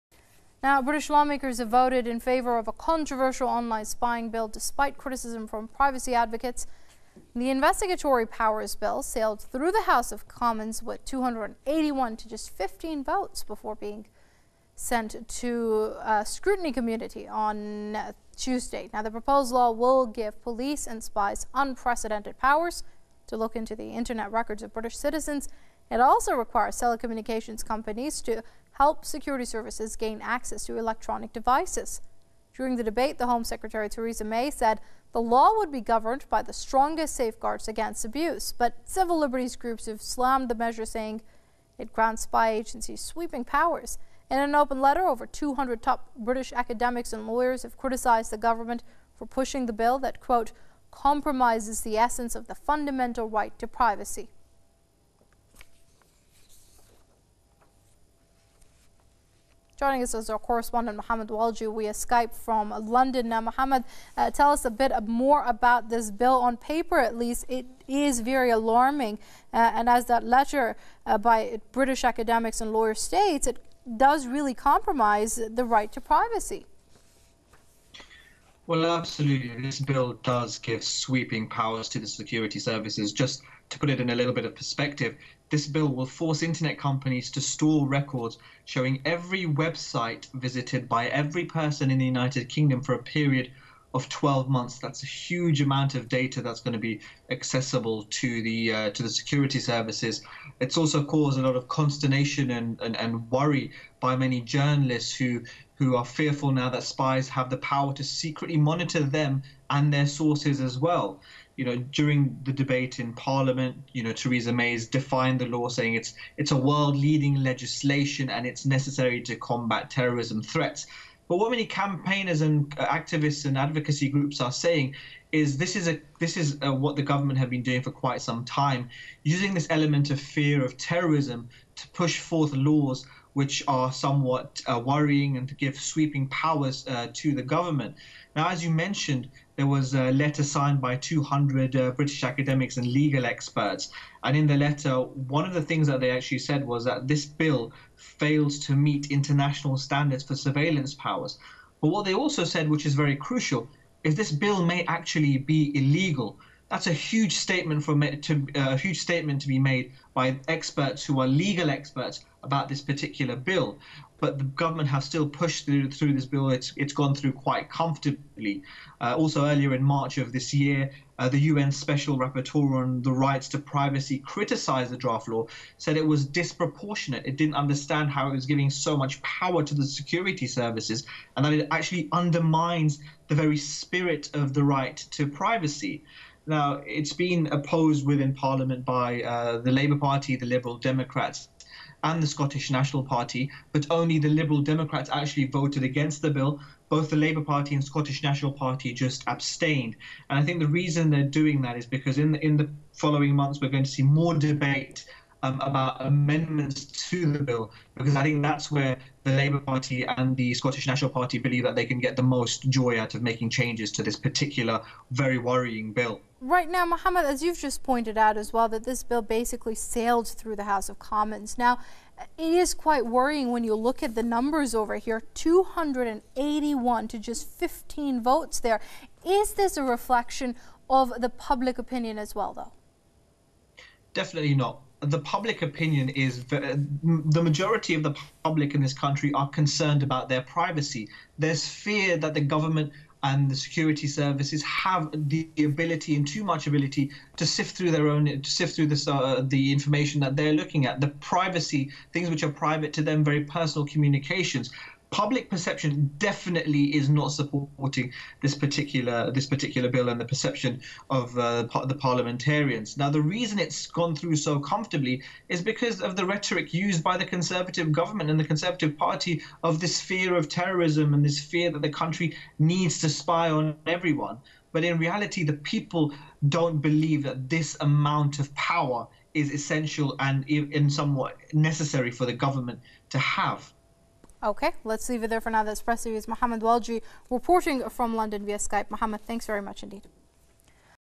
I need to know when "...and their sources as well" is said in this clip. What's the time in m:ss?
1:49.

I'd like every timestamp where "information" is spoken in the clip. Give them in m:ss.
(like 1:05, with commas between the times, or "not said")
4:09.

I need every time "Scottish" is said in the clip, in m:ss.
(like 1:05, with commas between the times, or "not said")
3:12, 3:17, 3:30.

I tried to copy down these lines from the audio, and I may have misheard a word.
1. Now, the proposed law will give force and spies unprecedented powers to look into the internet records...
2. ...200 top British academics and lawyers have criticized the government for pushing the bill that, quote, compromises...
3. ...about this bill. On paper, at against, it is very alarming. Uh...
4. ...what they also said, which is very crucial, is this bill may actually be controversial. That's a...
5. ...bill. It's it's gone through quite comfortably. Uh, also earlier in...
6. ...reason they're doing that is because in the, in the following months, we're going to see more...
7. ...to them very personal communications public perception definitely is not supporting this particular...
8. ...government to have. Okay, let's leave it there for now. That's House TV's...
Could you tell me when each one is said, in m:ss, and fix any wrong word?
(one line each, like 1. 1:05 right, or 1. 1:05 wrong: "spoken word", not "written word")
1. 0:18 wrong: "police", not "force"
2. 0:45 right
3. 1:05 wrong: "least", not "against"
4. 2:31 wrong: "illegal", not "controversial"
5. 2:46 right
6. 3:20 right
7. 4:12 right
8. 4:42 wrong: "Press", not "House".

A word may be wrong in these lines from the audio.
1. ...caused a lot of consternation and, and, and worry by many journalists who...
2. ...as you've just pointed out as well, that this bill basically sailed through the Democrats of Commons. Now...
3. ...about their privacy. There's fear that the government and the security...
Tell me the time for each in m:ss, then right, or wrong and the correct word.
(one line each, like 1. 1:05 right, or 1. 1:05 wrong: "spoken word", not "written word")
1. 1:41 right
2. 3:37 wrong: "House", not "Democrats"
3. 4:00 right.